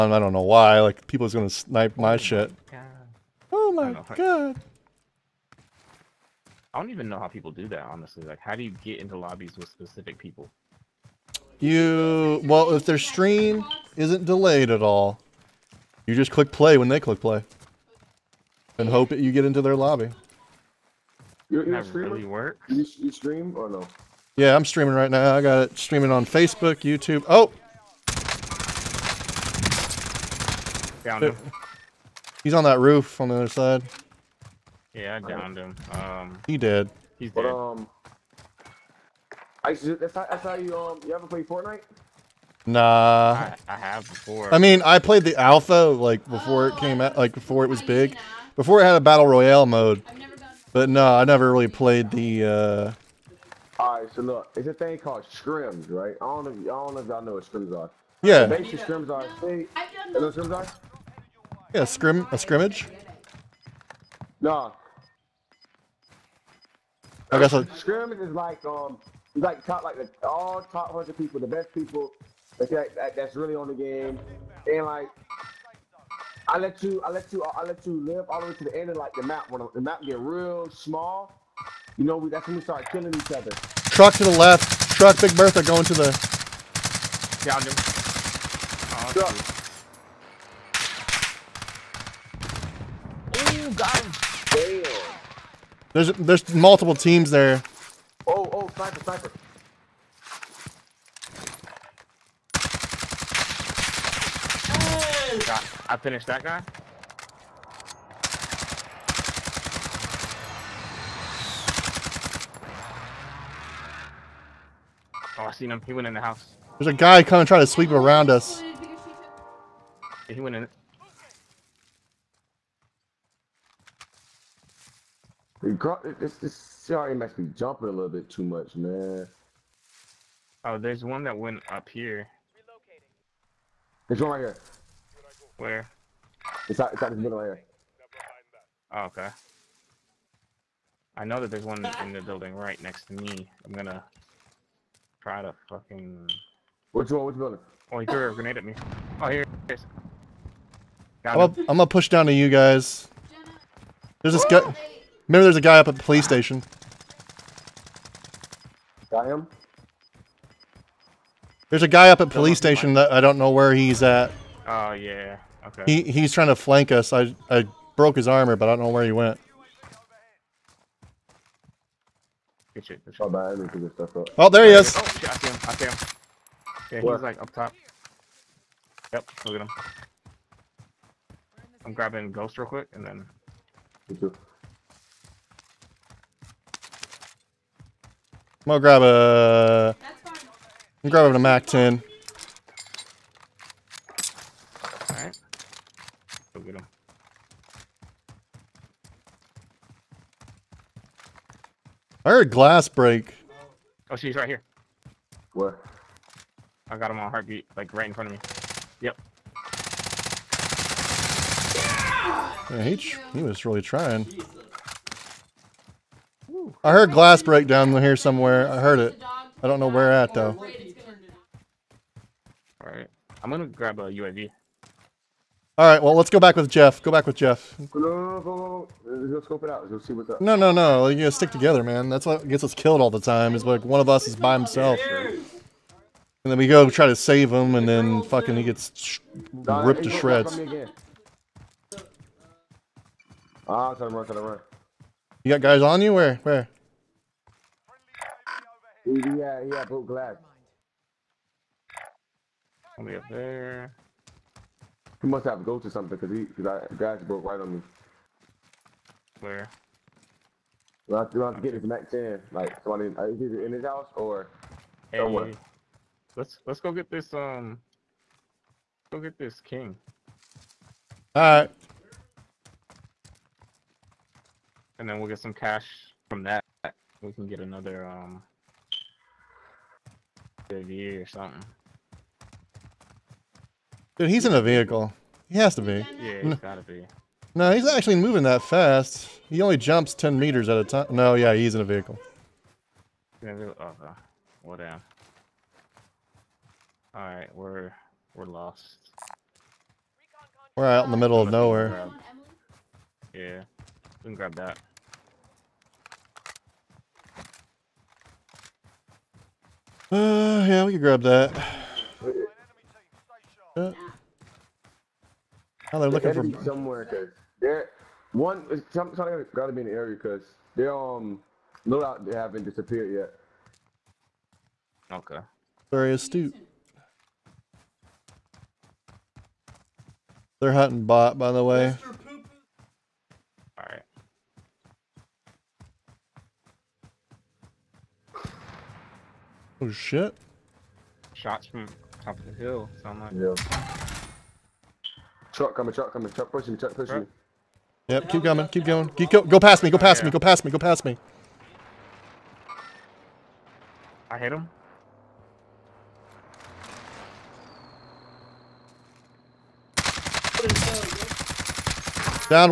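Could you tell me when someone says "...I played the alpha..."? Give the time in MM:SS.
00:44.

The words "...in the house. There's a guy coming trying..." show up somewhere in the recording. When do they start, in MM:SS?
01:56.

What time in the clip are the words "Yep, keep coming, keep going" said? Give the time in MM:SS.
05:48.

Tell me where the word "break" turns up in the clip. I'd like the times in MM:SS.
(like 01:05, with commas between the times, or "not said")
03:22, 03:37.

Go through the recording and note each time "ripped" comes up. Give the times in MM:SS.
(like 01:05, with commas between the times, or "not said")
03:59.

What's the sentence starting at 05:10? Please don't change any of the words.
Uh, yeah, we can grab that.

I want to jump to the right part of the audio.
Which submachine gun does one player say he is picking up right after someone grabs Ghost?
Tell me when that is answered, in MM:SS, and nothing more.
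03:11.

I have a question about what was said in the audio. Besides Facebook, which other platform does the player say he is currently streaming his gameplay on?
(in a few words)
YouTube.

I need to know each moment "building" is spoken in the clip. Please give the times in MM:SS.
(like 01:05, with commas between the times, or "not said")
02:22, 02:27.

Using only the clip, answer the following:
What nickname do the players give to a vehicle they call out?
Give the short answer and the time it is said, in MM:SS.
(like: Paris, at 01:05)
Big Bertha, at 01:25.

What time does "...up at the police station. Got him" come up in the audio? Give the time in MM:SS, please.
02:35.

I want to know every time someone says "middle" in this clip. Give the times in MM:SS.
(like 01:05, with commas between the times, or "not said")
02:17, 05:01.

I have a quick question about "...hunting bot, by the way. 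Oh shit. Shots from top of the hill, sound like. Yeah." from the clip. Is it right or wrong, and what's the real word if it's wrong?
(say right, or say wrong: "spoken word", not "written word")
right.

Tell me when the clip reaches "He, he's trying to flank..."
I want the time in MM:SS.
02:45.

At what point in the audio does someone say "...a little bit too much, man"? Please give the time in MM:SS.
02:07.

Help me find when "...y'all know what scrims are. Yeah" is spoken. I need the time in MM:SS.
00:57.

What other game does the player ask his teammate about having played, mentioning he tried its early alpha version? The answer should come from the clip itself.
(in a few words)
Fortnite.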